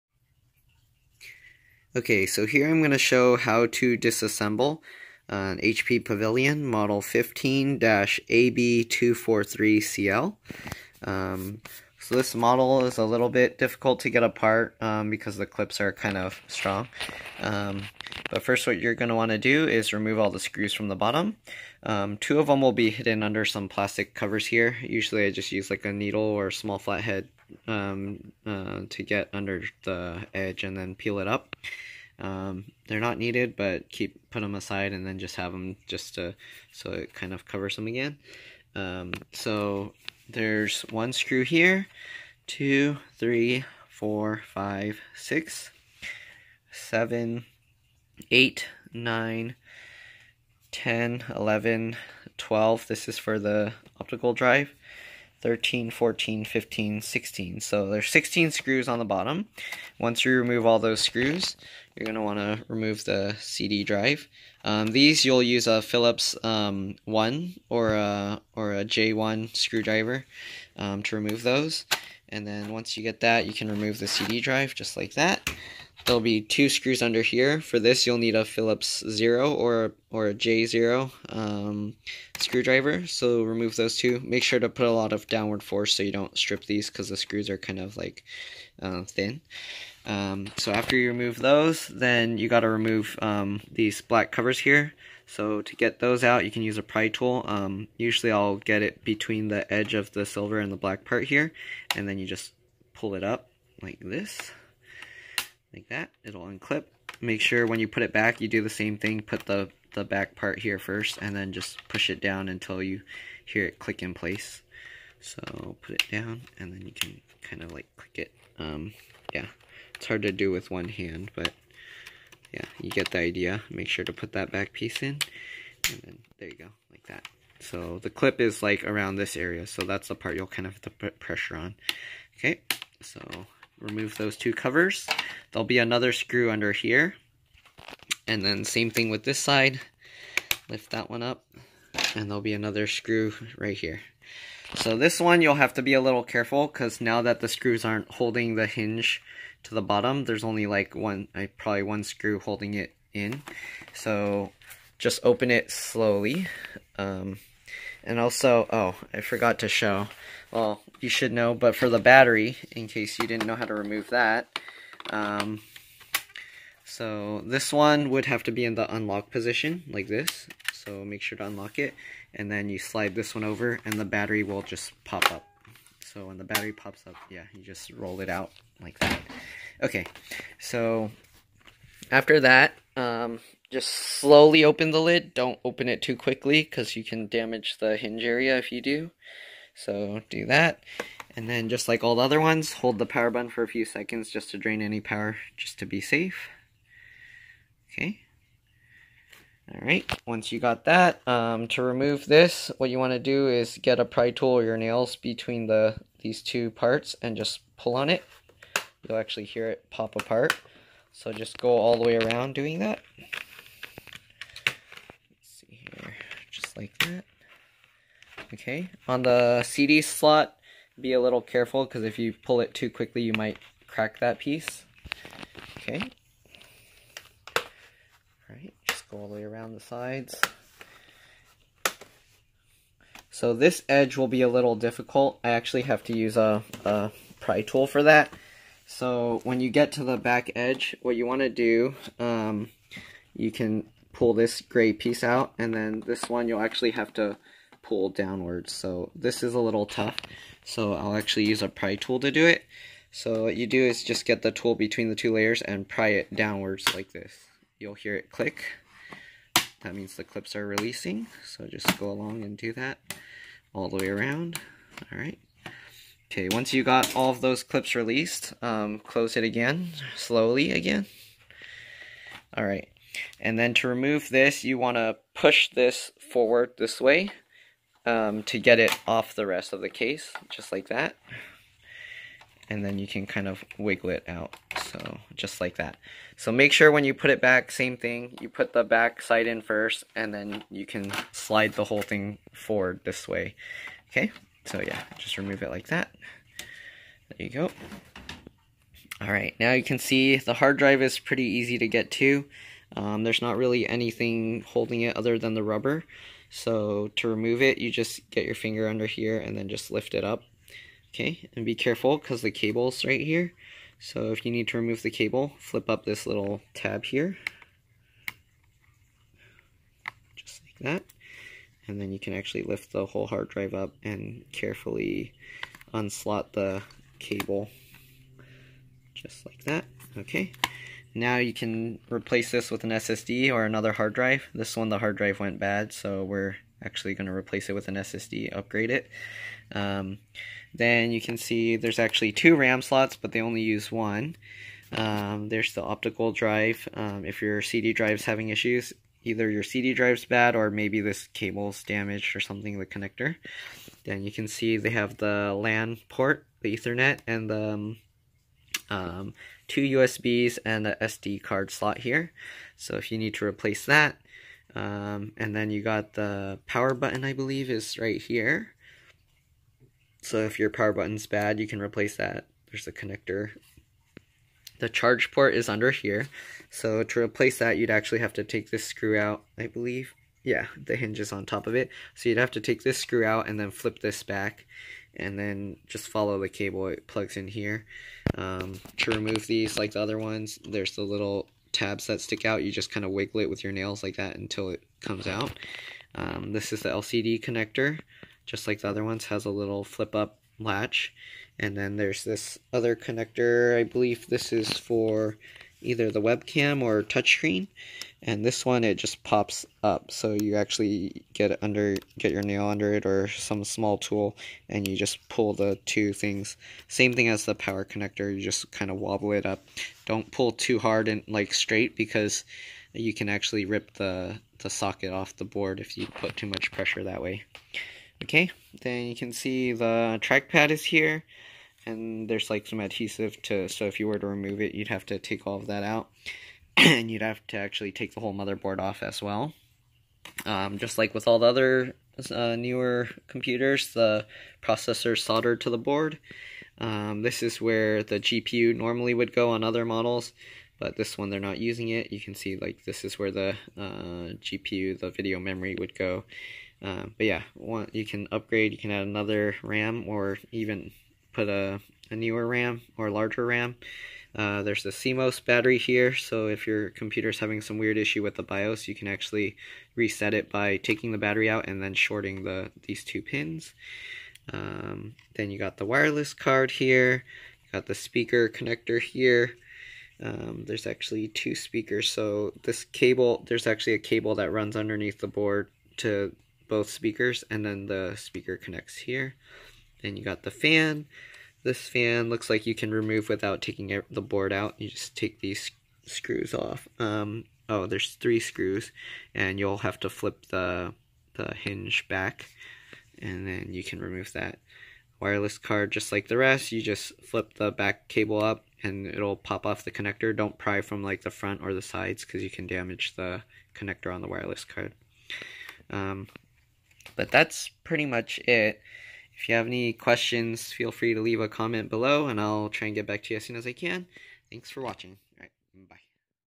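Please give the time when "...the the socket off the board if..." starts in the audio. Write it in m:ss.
7:03.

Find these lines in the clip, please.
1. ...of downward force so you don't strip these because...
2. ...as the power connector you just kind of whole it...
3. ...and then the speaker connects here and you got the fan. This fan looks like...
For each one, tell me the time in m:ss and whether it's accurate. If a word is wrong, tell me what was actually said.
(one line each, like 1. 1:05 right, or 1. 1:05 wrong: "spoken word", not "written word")
1. 1:25 right
2. 6:57 wrong: "wobble", not "whole"
3. 8:07 right.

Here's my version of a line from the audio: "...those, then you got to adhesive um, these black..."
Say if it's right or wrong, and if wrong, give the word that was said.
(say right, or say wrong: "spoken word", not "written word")
wrong: "remove", not "adhesive".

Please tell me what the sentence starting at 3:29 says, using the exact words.
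You'll actually hear it pop apart.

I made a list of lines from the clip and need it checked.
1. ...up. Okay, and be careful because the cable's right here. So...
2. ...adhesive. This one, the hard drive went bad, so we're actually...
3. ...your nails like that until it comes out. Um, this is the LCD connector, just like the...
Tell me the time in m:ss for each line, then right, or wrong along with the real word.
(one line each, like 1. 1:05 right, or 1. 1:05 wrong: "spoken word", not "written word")
1. 5:10 right
2. 5:34 wrong: "drive", not "adhesive"
3. 6:33 right.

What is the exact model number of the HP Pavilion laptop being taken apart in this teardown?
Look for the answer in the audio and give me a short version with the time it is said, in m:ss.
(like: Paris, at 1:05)
15-AB243CL, at 0:07.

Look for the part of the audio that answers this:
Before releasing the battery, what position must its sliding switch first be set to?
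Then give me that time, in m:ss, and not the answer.
2:48.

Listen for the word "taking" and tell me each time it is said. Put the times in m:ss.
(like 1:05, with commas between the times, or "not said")
7:50, 8:13.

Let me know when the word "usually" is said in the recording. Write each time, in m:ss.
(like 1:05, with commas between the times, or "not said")
0:24, 1:37.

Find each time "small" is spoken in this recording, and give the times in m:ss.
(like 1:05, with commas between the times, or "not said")
0:26, 6:53.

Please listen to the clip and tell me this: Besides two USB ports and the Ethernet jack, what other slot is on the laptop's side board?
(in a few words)
SD card slot.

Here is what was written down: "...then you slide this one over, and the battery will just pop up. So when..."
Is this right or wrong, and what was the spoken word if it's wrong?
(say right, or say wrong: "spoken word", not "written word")
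right.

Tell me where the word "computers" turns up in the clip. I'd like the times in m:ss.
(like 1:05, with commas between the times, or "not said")
7:23, 7:46.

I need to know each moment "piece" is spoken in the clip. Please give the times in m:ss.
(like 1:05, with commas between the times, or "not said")
2:04, 3:44, 4:04.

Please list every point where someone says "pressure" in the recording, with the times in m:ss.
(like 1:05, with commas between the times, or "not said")
2:11, 7:06.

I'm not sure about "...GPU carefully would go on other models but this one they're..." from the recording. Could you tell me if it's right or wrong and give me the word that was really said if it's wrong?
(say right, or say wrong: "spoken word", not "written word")
wrong: "normally", not "carefully".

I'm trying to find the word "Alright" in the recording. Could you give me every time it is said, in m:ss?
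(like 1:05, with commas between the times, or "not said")
3:19, 3:48, 4:25, 4:32, 4:59.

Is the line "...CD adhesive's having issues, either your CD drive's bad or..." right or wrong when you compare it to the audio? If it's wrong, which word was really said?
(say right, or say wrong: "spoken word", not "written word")
wrong: "drive", not "adhesive".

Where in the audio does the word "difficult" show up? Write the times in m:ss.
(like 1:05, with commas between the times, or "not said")
0:13, 3:54.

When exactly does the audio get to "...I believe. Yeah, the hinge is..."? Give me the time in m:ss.
6:19.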